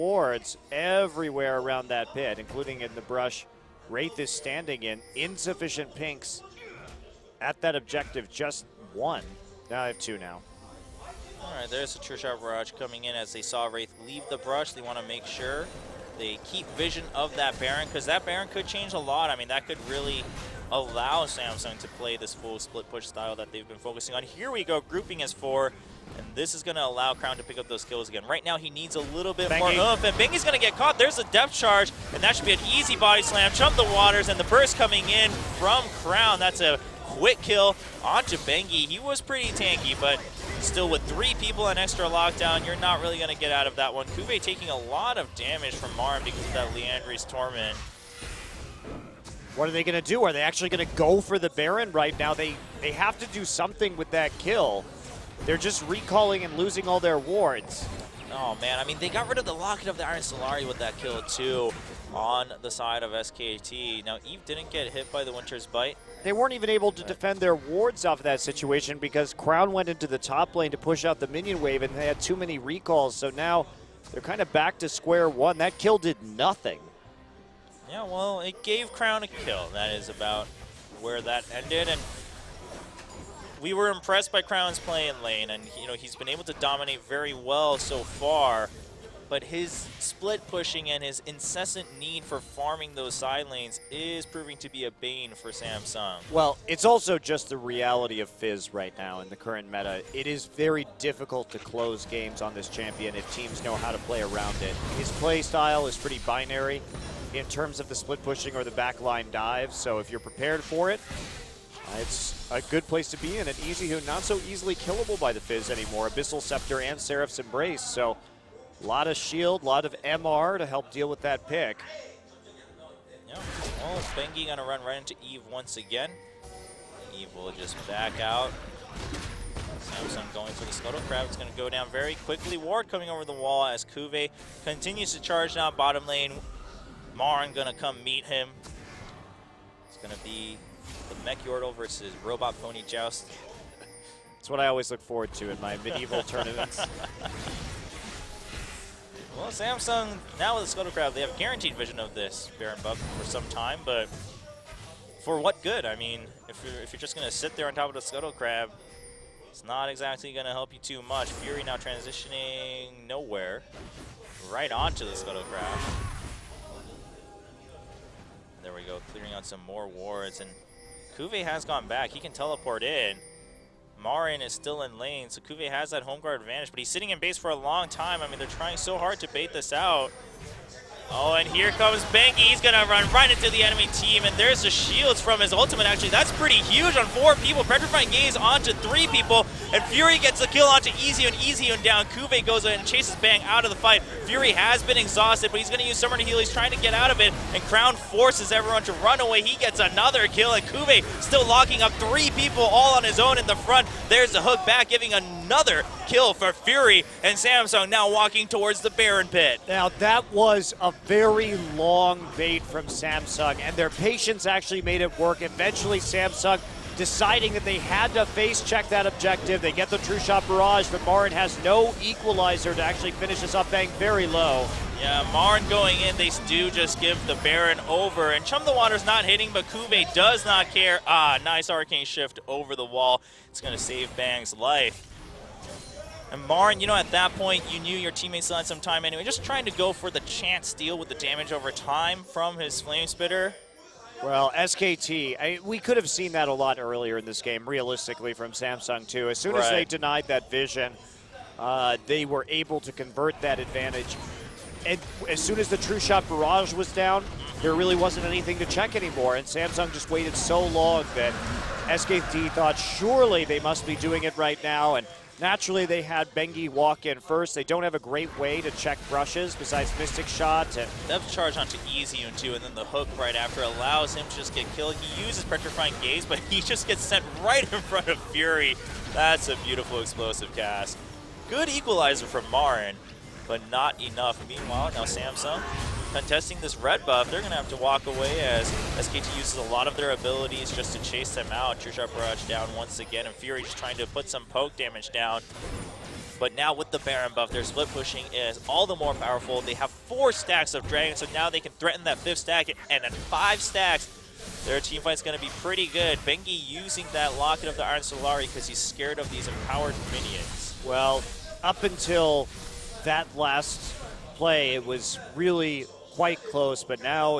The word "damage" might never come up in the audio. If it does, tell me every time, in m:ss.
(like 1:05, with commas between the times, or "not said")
0:45, 4:01, 4:54.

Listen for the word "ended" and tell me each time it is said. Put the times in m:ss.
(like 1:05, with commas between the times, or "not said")
1:21.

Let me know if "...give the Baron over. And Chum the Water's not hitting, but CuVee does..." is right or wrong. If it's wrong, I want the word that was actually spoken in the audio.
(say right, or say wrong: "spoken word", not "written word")
right.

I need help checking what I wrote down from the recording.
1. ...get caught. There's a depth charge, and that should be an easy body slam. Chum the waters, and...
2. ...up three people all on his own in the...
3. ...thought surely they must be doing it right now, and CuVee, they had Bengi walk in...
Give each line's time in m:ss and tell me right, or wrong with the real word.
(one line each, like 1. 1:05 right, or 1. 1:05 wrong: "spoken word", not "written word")
1. 0:30 right
2. 3:21 right
3. 4:22 wrong: "Naturally", not "CuVee".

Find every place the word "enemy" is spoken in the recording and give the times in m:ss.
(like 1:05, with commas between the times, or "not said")
3:03.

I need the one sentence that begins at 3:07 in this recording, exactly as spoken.
Petrifying Gaze onto three people, and Fury gets the kill onto Easy and Easy and down.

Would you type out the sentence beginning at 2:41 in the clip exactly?
Fury now transitioning nowhere, right onto the Scuttle Crab.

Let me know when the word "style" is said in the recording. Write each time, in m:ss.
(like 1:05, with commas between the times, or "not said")
0:23, 1:45.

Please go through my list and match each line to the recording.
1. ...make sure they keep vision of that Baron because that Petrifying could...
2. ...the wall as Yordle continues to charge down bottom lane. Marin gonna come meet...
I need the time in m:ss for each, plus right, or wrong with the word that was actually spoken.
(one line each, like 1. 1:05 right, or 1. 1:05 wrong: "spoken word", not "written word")
1. 0:15 wrong: "Baron", not "Petrifying"
2. 2:13 wrong: "CuVee", not "Yordle".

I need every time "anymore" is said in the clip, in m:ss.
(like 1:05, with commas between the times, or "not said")
1:55, 4:18.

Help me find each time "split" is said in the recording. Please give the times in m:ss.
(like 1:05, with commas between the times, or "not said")
0:22, 1:29, 1:47, 4:57.